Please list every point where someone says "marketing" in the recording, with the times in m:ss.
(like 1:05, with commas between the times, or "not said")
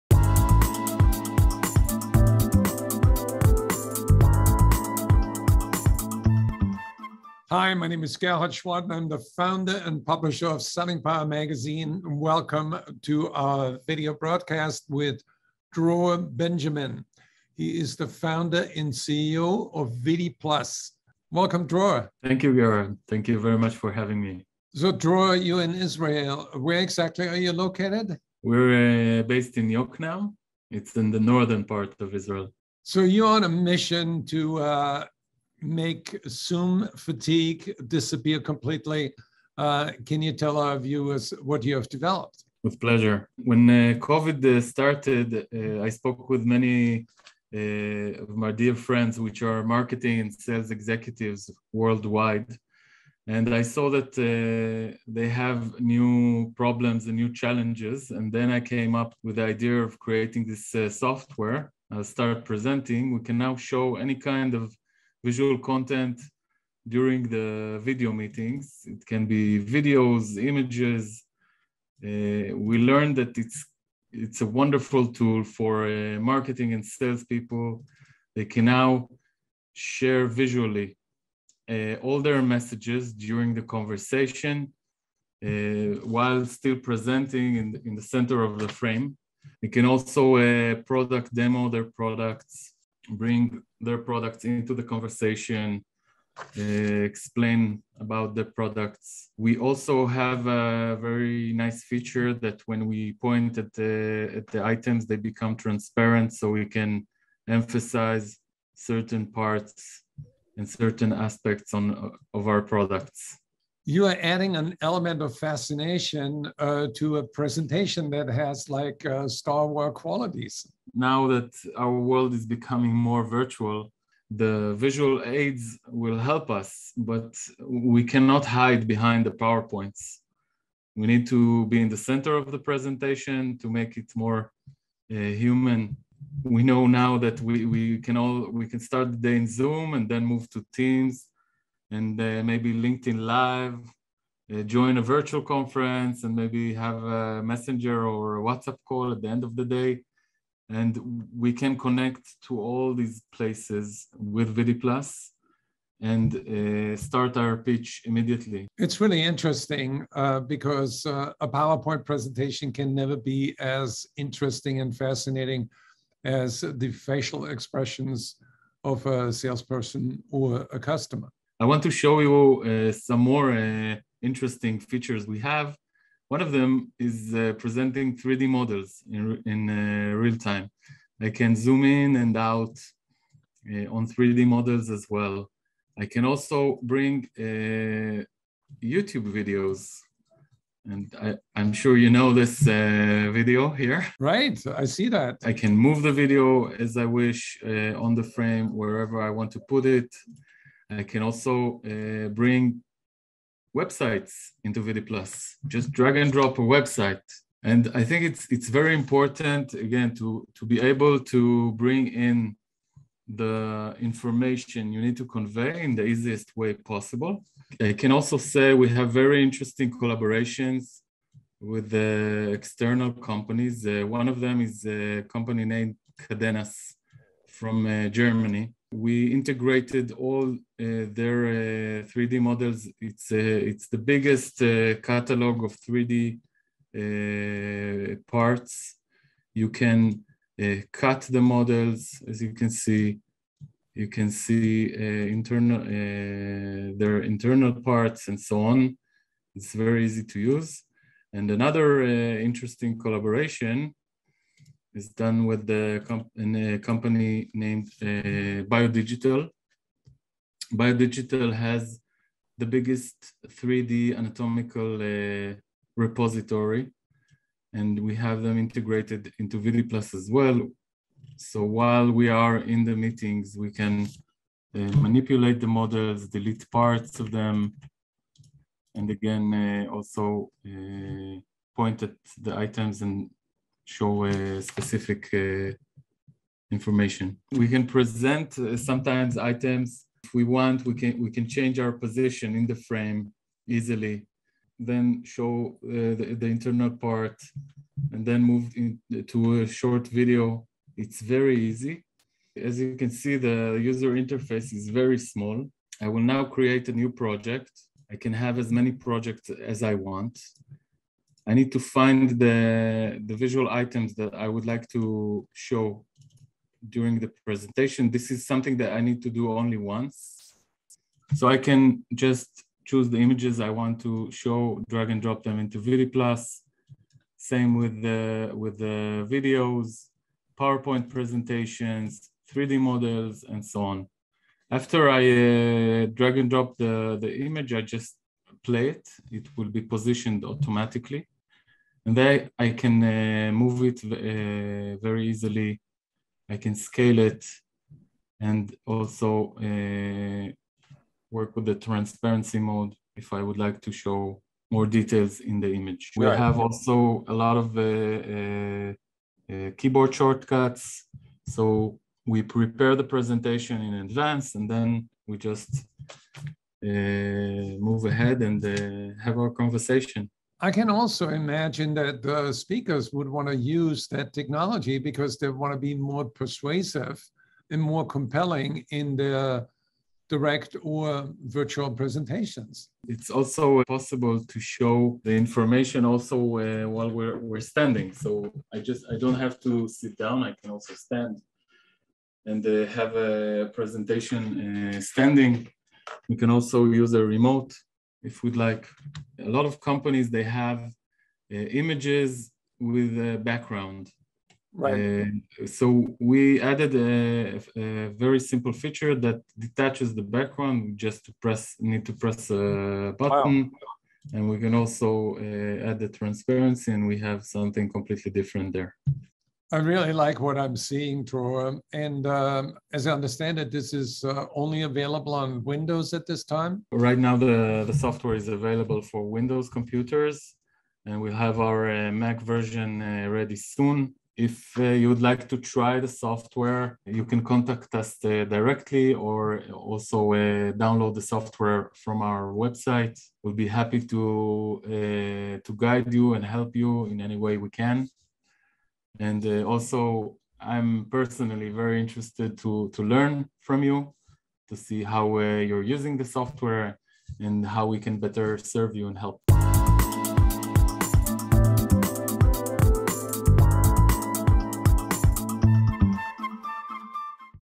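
0:49, 1:16.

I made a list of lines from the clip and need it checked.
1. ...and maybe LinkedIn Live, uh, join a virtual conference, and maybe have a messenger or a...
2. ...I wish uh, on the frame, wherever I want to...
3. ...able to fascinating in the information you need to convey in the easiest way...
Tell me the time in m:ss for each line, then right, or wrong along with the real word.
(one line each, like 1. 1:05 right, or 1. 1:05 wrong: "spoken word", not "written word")
1. 2:21 right
2. 3:16 right
3. 3:30 wrong: "bring", not "fascinating".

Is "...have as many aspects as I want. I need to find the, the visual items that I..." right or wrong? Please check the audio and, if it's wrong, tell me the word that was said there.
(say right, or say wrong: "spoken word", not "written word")
wrong: "projects", not "aspects".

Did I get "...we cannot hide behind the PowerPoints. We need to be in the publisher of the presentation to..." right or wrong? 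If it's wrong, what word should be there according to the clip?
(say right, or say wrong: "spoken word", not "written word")
wrong: "center", not "publisher".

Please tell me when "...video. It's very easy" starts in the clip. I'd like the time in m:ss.
5:00.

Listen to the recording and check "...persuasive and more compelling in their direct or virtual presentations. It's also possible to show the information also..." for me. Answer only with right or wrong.
right.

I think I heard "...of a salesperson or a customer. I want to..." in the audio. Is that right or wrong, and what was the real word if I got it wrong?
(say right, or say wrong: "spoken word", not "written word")
right.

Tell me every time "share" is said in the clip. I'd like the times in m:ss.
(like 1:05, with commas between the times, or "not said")
1:19.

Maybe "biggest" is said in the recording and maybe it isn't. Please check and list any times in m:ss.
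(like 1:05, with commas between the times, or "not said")
3:53, 4:22.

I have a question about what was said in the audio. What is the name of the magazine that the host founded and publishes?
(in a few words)
Selling Power Magazine.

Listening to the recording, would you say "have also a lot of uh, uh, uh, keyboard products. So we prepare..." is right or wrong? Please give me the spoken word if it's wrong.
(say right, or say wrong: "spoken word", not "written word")
wrong: "shortcuts", not "products".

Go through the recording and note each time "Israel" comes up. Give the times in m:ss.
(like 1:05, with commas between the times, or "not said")
0:25, 0:32.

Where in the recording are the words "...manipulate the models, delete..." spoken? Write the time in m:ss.
4:35.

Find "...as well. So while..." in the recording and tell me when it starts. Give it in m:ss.
4:30.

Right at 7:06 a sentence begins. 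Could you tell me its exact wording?
Right now, the, the software is available for Windows computers, and we'll have our uh, Mac version uh, ready soon.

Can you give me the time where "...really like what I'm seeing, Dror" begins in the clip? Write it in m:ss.
6:59.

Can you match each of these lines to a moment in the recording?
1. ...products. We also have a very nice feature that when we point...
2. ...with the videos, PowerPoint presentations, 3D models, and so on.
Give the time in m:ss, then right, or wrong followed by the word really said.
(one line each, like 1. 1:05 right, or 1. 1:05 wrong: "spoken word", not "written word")
1. 1:38 right
2. 5:28 right.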